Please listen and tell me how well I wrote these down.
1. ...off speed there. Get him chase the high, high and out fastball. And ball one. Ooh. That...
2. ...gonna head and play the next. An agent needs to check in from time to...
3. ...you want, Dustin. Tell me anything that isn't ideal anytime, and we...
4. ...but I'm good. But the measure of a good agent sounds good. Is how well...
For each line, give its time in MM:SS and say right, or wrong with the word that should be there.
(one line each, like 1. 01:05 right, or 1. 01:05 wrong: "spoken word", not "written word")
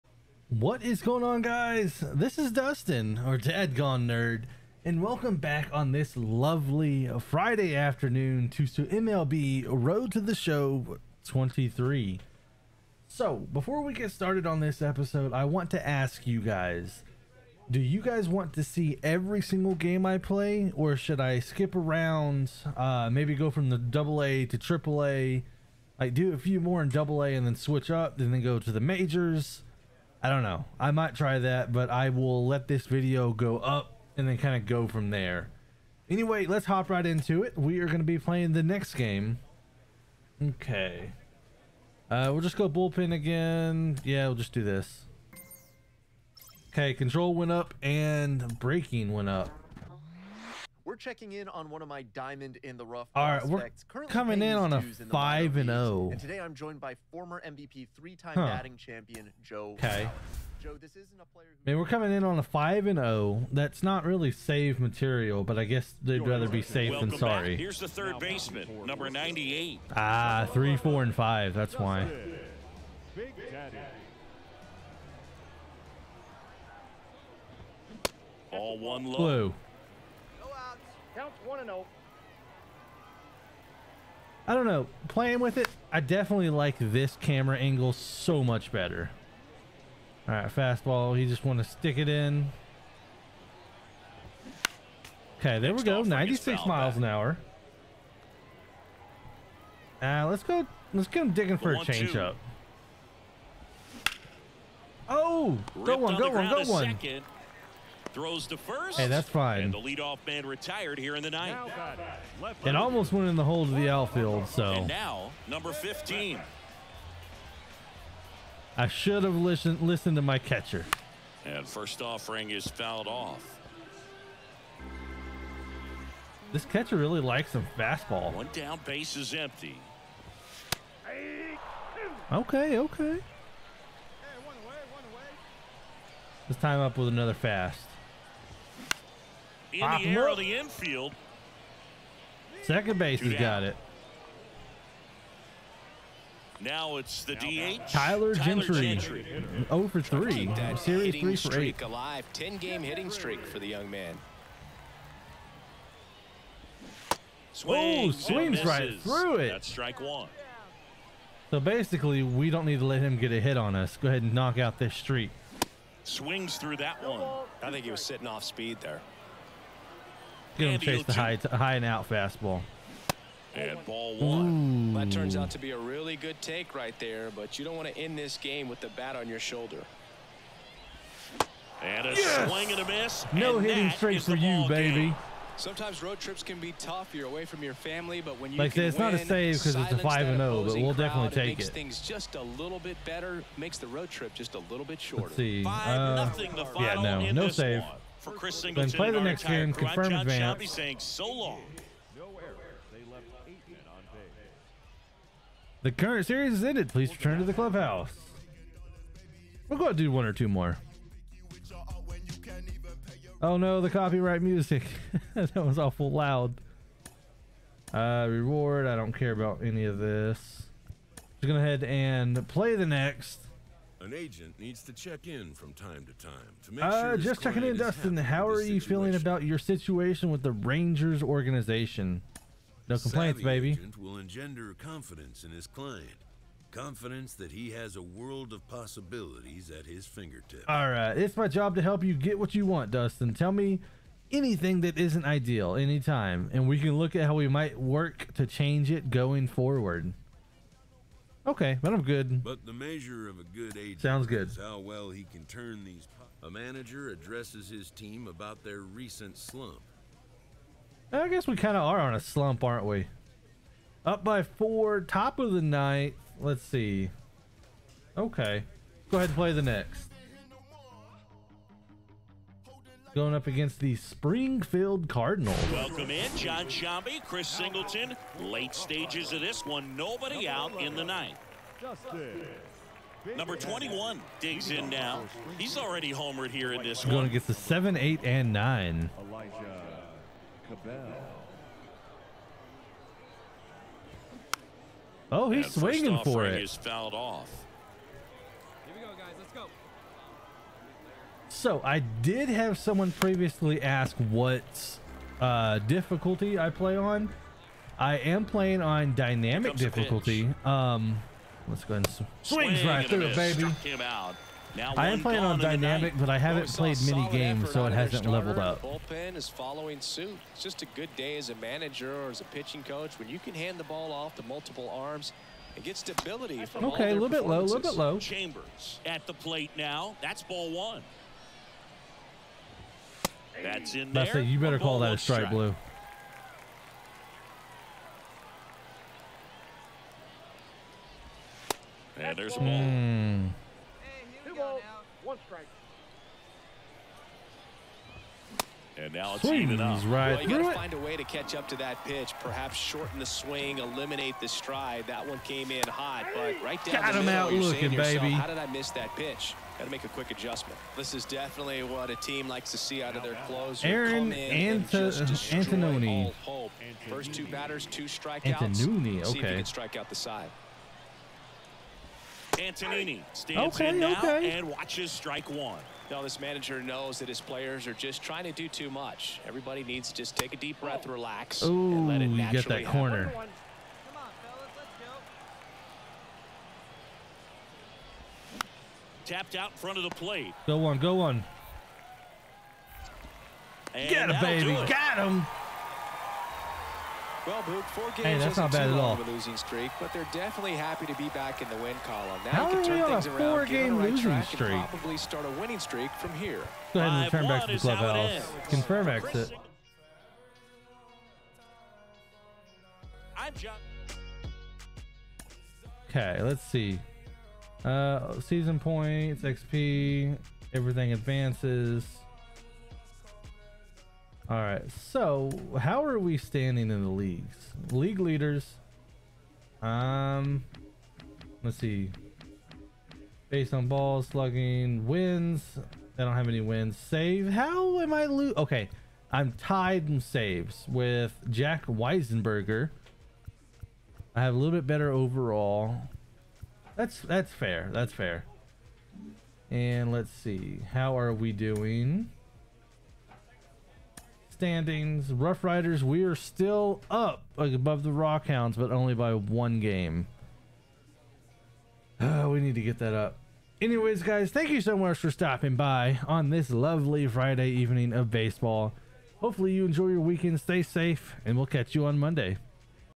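1. 02:48 right
2. 03:41 right
3. 04:02 right
4. 04:11 right.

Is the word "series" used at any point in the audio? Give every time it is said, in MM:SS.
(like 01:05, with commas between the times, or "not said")
02:30, 03:26.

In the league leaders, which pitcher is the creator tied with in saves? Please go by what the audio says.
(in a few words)
Jack Weisenberger.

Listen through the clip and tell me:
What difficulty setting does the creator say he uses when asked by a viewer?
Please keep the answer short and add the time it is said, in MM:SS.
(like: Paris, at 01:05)
Dynamic difficulty, at 05:09.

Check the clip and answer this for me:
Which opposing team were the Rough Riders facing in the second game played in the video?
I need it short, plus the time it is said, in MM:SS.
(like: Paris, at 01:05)
Springfield Cardinals, at 04:33.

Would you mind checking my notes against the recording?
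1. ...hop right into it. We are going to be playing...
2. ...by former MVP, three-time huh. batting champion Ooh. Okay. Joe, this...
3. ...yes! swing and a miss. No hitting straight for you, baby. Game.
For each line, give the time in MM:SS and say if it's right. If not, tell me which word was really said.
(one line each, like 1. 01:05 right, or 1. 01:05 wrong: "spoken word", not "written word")
1. 00:36 right
2. 00:56 wrong: "Joe", not "Ooh"
3. 03:02 right.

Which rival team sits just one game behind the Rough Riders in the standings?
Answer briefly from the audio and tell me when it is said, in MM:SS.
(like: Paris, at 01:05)
Rockhounds, at 07:38.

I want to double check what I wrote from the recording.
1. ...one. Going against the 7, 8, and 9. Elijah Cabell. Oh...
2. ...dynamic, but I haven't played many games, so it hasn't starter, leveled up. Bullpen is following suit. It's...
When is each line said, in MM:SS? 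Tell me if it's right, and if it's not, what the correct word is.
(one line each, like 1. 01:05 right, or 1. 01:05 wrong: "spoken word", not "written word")
1. 04:47 right
2. 05:15 right.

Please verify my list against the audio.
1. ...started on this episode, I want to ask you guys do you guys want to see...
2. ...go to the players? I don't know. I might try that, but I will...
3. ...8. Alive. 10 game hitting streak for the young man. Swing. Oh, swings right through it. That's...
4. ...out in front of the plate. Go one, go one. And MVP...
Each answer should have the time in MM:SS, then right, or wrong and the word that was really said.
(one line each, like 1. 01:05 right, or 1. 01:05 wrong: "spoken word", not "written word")
1. 00:14 right
2. 00:28 wrong: "majors", not "players"
3. 02:31 right
4. 06:29 wrong: "Get", not "MVP".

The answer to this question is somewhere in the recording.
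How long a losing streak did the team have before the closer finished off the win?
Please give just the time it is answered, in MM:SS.
06:43.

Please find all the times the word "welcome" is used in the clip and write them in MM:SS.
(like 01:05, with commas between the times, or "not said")
00:05, 04:35.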